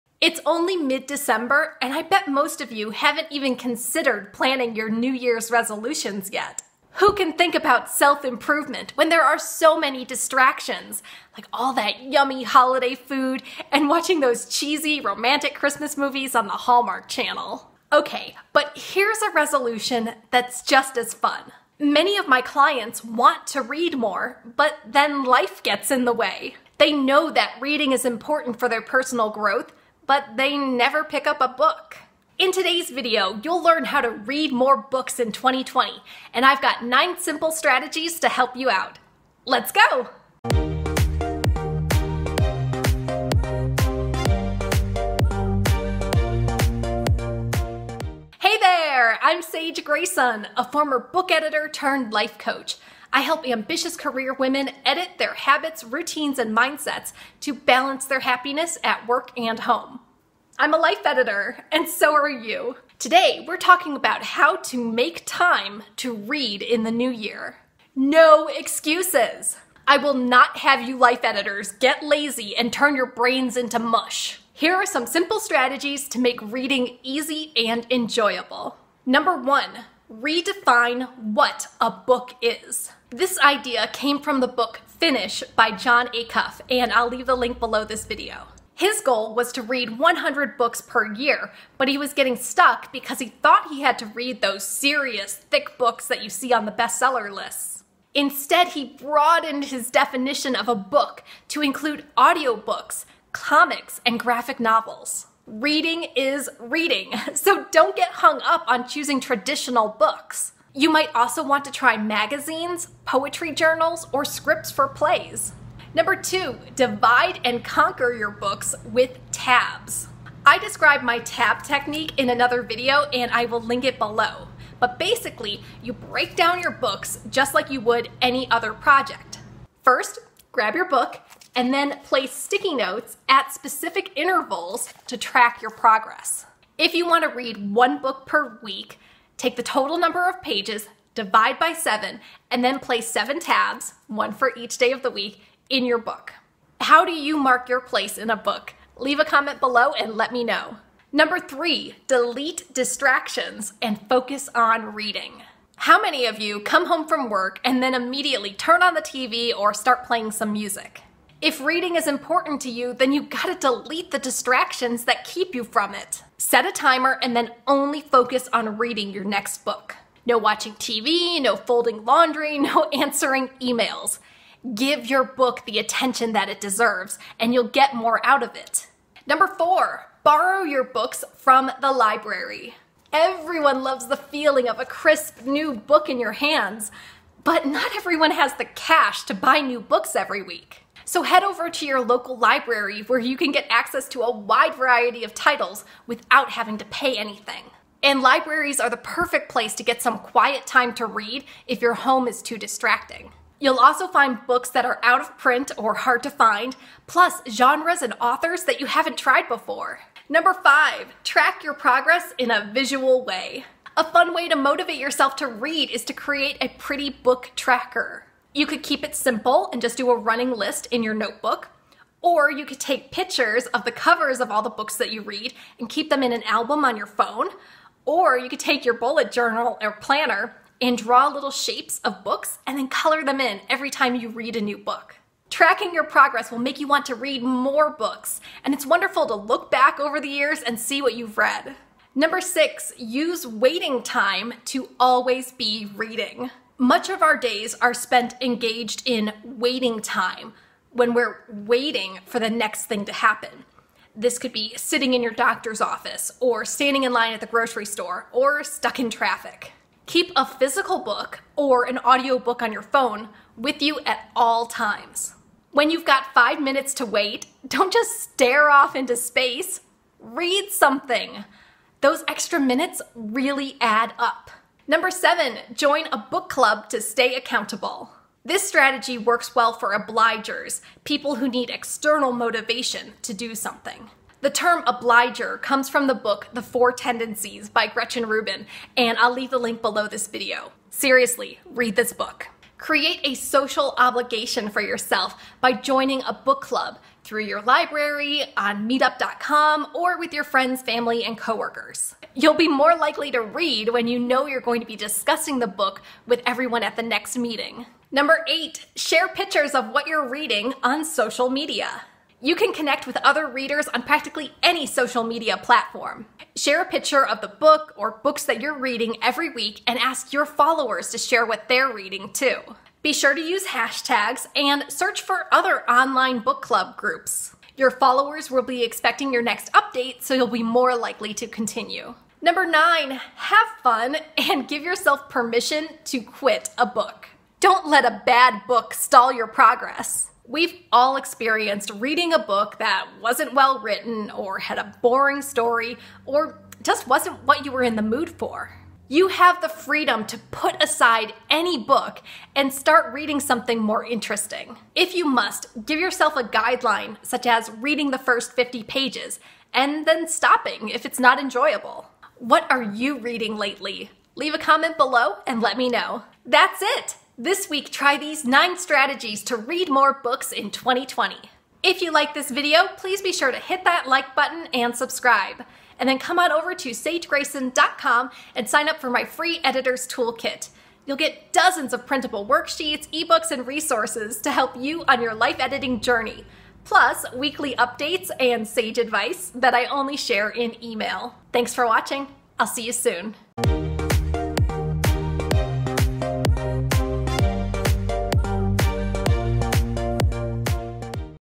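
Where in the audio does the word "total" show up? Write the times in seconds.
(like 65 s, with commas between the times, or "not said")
139 s.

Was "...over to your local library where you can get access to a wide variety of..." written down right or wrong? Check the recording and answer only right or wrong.
right.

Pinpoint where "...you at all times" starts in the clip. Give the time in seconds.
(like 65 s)
263 s.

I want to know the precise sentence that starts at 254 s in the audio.
This could be sitting in your doctor's office, or standing in line at the grocery store, or stuck in traffic.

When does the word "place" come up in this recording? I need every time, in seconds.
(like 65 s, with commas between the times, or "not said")
132 s, 142 s, 147 s, 199 s.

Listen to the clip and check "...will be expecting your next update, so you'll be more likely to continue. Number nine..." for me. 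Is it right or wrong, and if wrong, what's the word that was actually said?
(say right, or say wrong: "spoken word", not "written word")
right.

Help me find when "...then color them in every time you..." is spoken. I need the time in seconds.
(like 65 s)
232 s.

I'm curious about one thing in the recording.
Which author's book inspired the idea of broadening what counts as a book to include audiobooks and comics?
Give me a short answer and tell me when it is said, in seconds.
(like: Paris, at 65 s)
Jon Acuff, at 85 s.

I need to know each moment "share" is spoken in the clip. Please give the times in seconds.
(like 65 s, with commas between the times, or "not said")
308 s, 316 s, 321 s, 390 s.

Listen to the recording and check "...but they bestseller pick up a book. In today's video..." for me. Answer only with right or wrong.
wrong.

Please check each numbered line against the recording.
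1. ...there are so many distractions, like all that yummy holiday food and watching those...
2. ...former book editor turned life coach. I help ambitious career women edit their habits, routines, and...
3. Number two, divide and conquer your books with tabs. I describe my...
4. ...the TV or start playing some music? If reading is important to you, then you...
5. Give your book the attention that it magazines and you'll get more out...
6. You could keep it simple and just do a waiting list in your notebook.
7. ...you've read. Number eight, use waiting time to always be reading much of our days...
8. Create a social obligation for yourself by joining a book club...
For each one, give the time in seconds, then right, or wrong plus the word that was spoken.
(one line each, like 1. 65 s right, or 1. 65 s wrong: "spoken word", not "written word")
1. 9 s right
2. 50 s right
3. 115 s right
4. 158 s right
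5. 174 s wrong: "deserves", not "magazines"
6. 218 s wrong: "running", not "waiting"
7. 241 s wrong: "six", not "eight"
8. 292 s right.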